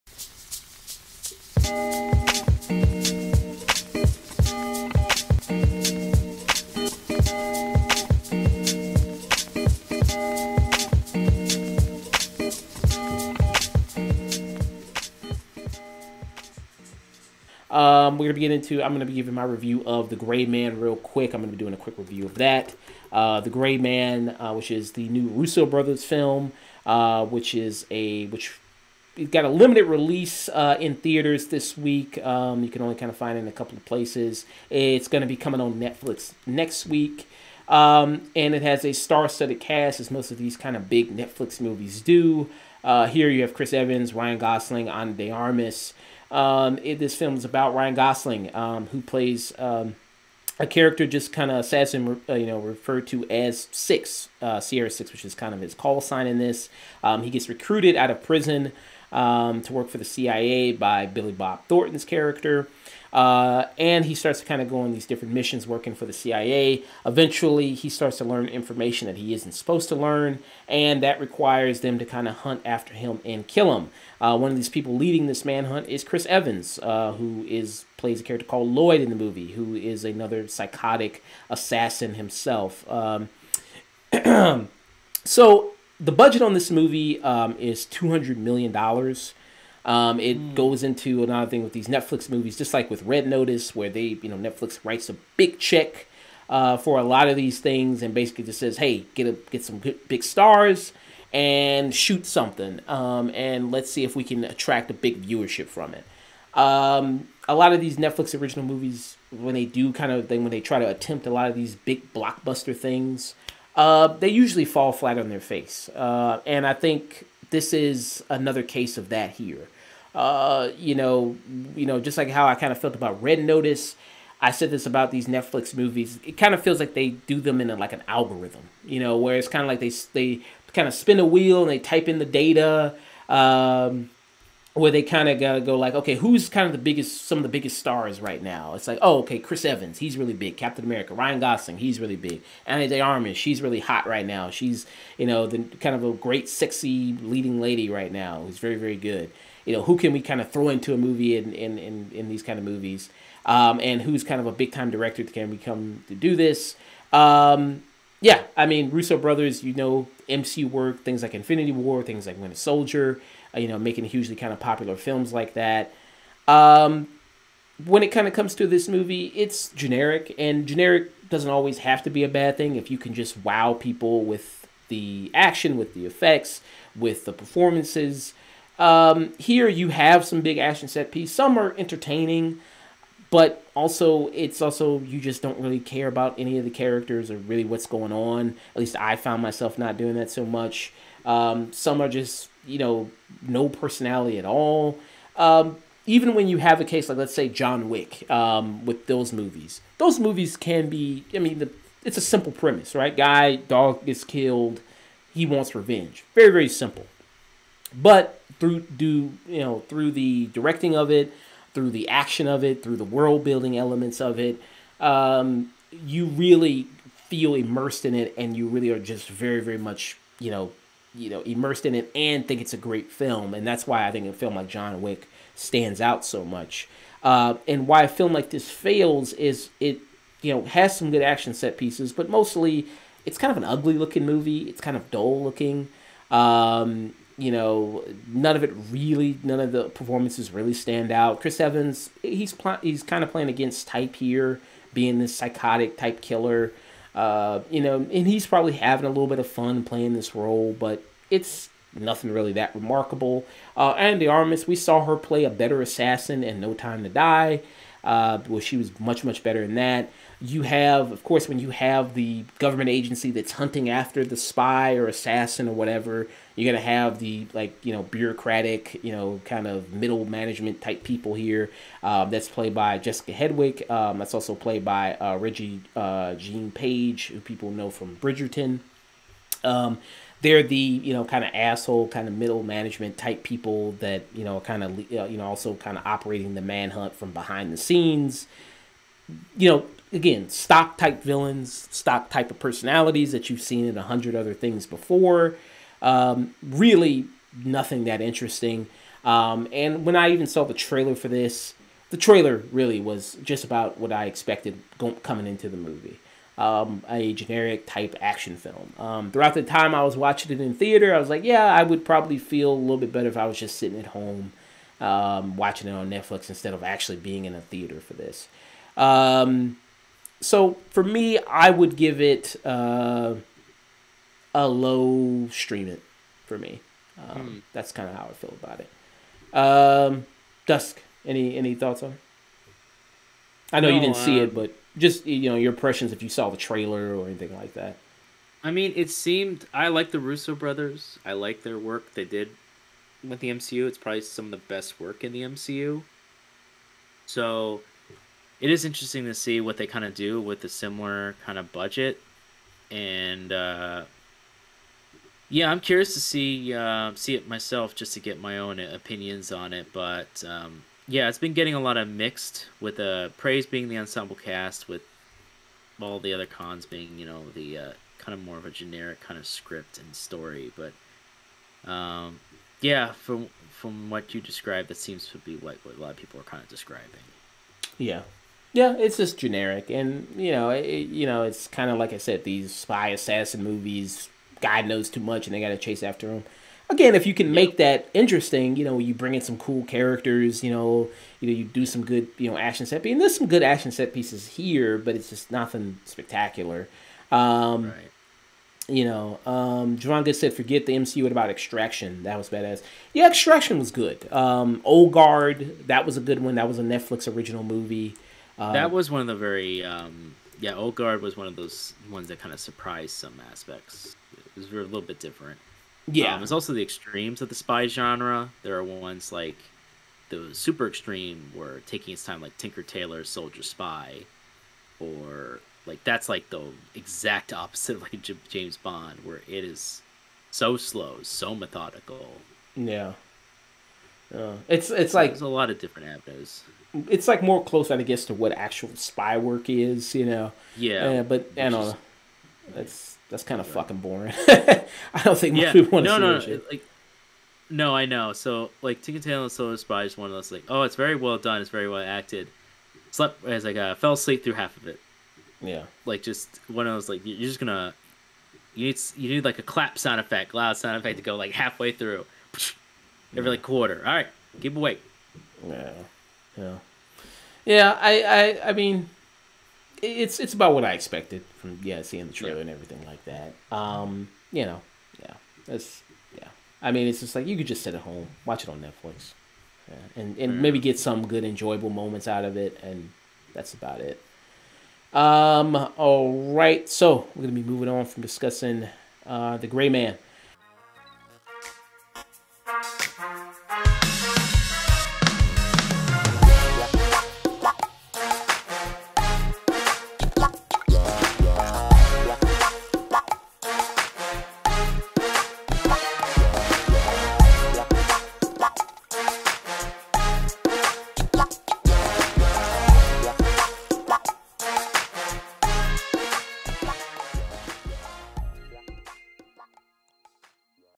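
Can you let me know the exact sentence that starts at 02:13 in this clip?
Um, where they kind of got to go like, okay, who's kind of the biggest, some of the biggest stars right now?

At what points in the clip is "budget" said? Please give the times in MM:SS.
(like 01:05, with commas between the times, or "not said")
01:26, 05:51.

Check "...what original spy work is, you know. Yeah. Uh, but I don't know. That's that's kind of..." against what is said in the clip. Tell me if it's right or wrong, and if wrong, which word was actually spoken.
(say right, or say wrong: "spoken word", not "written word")
wrong: "actual", not "original".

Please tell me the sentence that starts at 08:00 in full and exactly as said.
maybe get some good enjoyable moments out of it, and that's about it.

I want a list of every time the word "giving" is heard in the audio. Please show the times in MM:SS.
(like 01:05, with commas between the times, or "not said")
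00:19.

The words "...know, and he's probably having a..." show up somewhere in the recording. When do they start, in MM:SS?
04:07.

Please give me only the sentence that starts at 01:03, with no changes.
Uh, and he starts to kind of go on these different missions working for the CIA.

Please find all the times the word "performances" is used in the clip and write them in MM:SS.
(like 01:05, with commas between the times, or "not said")
02:57, 03:59.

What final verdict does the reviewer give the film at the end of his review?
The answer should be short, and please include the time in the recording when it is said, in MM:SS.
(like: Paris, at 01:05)
Low stream it, at 05:24.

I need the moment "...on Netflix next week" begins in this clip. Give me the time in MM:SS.
00:35.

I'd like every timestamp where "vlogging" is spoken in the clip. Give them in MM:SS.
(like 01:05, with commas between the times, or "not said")
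not said.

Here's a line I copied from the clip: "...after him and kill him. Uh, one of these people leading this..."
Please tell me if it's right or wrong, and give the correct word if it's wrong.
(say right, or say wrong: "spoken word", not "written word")
right.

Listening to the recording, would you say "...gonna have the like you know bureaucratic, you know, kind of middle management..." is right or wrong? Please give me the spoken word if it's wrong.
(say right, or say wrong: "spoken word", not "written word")
right.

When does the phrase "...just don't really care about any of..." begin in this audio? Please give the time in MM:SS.
03:05.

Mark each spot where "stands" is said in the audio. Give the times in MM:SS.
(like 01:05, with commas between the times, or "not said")
03:45, 04:00.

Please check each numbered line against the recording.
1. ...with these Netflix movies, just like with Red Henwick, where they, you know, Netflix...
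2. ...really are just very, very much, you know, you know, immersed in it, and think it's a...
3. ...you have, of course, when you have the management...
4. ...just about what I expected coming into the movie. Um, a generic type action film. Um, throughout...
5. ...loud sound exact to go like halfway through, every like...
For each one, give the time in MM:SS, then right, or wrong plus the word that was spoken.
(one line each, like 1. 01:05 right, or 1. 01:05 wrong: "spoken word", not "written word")
1. 01:31 wrong: "Notice", not "Henwick"
2. 03:38 right
3. 04:20 wrong: "government", not "management"
4. 05:03 right
5. 07:40 wrong: "effect", not "exact".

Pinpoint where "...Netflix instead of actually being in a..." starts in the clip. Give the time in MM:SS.
05:16.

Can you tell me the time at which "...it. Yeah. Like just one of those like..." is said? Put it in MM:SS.
07:34.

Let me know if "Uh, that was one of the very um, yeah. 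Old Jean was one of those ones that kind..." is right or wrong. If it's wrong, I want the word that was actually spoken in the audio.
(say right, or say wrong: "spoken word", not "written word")
wrong: "Guard", not "Jean".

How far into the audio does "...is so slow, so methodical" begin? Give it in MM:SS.
07:09.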